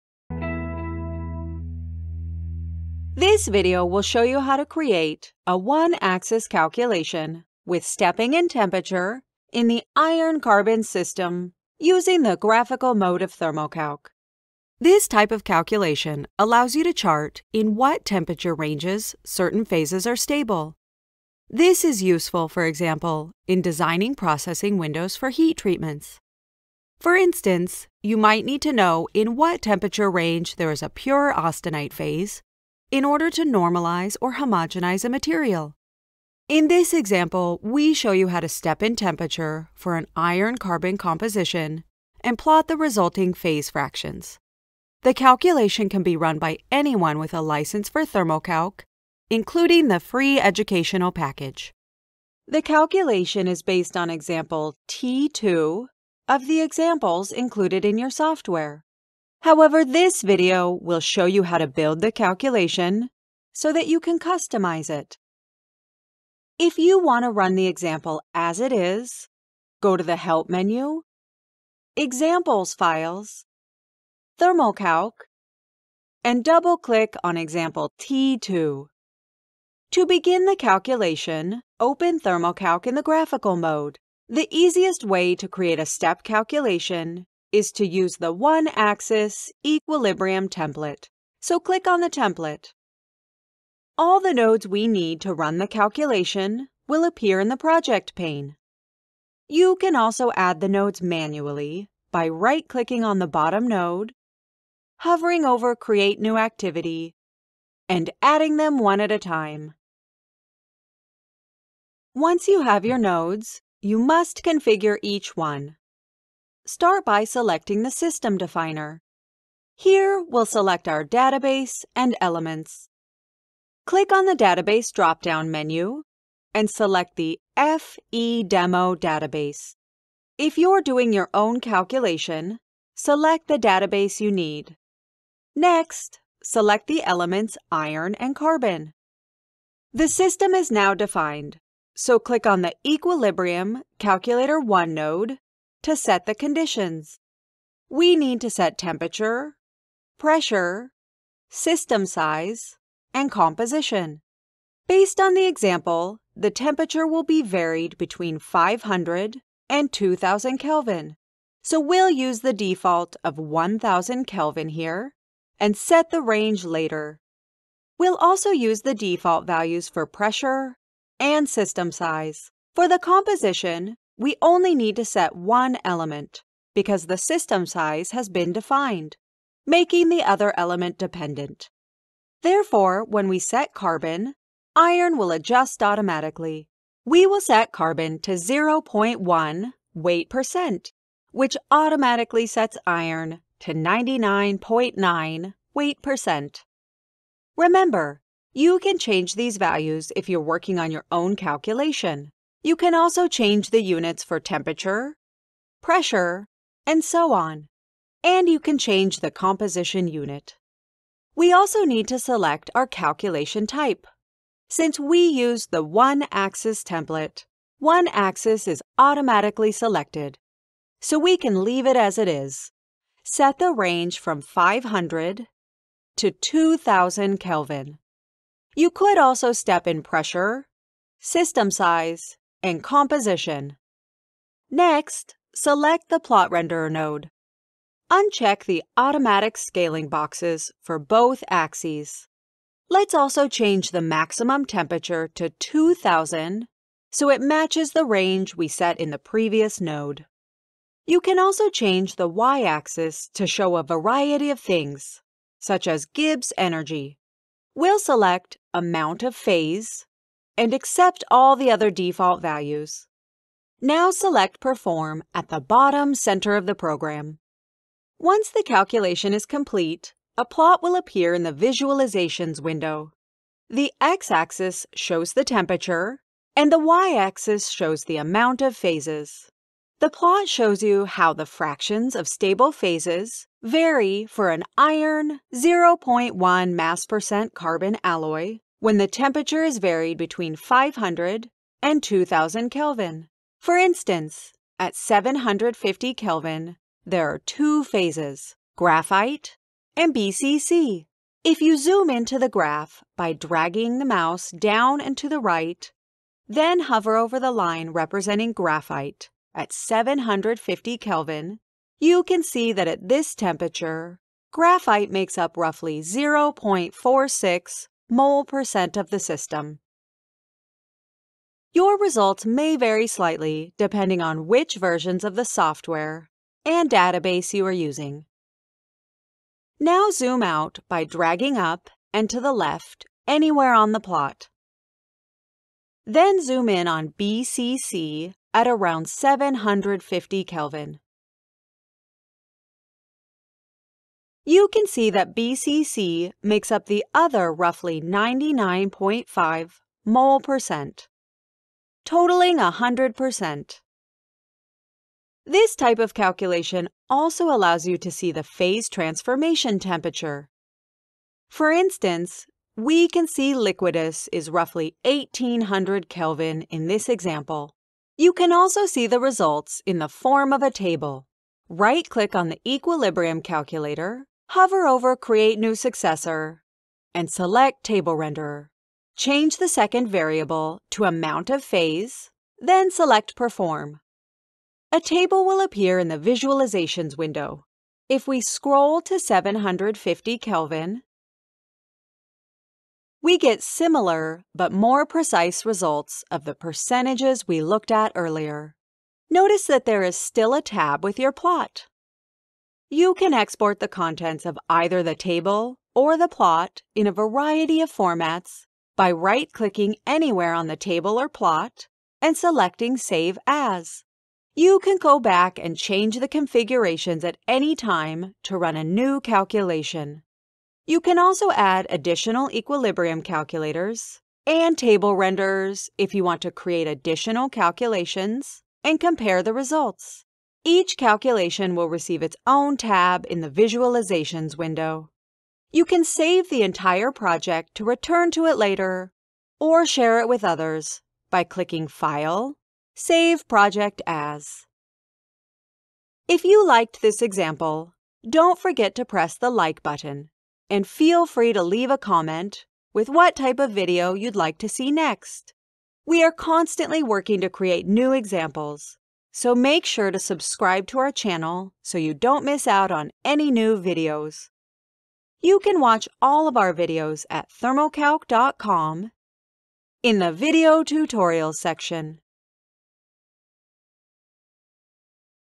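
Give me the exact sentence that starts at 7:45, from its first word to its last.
You can watch all of our videos at thermocalc.com in the video tutorials section.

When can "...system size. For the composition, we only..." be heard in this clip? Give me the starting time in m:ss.
2:51.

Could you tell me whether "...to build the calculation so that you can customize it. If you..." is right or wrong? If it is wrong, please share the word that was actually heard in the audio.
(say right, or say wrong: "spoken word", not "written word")
right.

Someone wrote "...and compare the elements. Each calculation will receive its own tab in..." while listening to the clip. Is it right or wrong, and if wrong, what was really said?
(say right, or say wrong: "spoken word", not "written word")
wrong: "results", not "elements".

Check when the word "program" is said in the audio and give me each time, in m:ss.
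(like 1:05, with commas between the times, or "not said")
4:26.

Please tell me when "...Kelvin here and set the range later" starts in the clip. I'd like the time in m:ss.
2:44.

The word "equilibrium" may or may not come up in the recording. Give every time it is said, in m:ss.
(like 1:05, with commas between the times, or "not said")
1:29, 2:22, 6:12, 7:02.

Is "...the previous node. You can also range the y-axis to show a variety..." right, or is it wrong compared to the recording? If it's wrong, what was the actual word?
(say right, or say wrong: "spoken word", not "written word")
wrong: "change", not "range".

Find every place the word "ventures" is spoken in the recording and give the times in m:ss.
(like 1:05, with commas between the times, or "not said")
not said.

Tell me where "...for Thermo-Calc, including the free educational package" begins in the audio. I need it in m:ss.
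0:47.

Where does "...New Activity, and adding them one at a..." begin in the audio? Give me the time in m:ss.
1:46.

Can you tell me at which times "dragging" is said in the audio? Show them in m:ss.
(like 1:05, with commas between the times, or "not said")
5:03, 5:31.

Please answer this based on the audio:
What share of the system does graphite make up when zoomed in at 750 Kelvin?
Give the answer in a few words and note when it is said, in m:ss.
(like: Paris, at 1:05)
0.46 mole percent, at 5:16.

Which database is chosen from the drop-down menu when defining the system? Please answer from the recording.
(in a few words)
FE Demo.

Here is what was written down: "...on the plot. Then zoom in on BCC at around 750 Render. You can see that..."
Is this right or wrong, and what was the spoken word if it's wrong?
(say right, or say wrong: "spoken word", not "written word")
wrong: "Kelvin", not "Render".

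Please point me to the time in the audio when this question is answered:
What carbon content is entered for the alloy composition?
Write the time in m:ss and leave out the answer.
3:08.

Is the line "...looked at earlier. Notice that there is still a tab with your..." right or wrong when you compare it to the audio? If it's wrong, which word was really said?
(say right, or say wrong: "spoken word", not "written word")
right.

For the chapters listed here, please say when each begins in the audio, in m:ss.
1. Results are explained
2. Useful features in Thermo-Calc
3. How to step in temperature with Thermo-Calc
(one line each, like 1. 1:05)
1. 4:28
2. 6:54
3. 0:52.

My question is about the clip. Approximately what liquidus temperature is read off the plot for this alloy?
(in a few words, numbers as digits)
1800 Kelvin.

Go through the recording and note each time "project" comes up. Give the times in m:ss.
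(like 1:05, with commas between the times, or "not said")
1:37, 7:17, 7:23.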